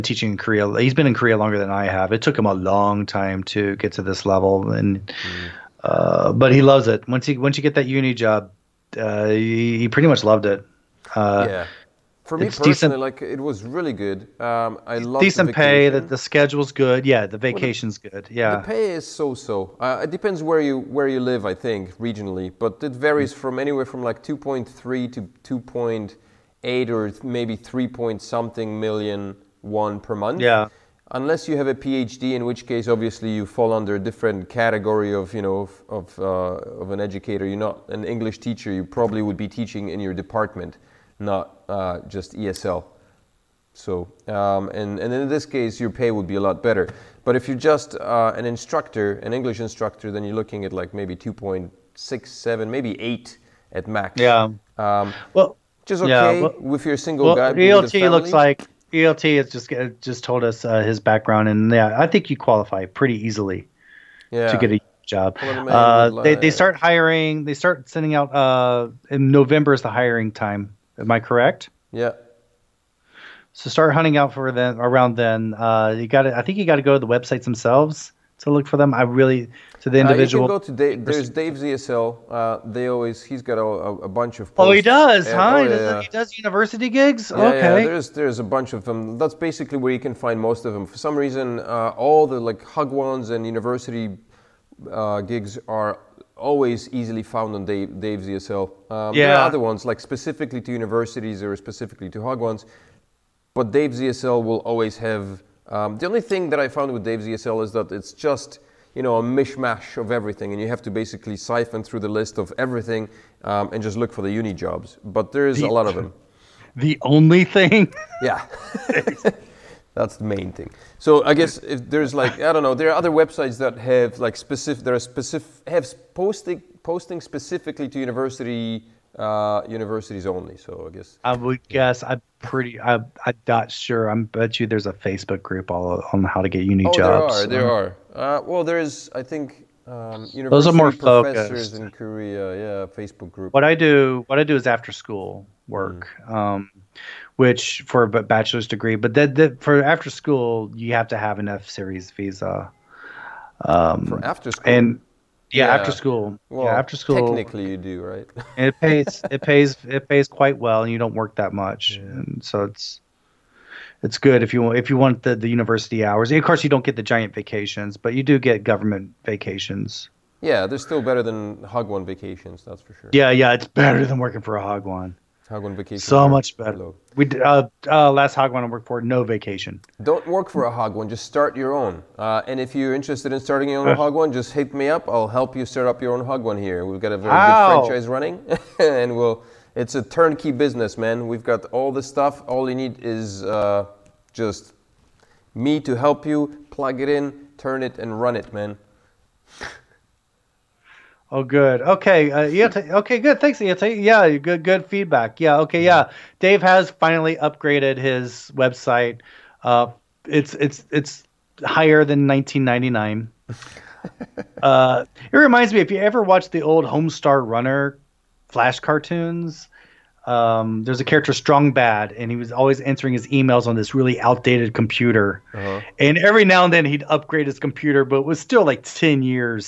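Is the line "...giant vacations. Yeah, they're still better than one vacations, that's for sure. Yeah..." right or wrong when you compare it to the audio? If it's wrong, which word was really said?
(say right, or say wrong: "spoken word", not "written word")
wrong: "government", not "giant".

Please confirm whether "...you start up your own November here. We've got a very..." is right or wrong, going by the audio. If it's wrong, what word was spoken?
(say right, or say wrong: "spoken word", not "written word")
wrong: "Hagwon", not "November".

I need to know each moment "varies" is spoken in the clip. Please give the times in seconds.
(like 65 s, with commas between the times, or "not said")
22 s.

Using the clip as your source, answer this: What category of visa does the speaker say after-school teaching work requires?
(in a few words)
F series visa.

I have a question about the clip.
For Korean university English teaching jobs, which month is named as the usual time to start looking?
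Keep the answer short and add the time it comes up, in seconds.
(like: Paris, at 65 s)
November, at 69 s.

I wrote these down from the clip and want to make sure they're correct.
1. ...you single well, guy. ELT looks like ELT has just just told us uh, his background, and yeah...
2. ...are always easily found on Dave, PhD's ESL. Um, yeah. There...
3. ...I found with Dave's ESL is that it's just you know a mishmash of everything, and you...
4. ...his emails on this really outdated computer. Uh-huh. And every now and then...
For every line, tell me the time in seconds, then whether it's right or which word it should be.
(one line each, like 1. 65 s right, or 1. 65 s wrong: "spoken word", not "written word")
1. 56 s right
2. 95 s wrong: "Dave", not "PhD"
3. 106 s right
4. 223 s right.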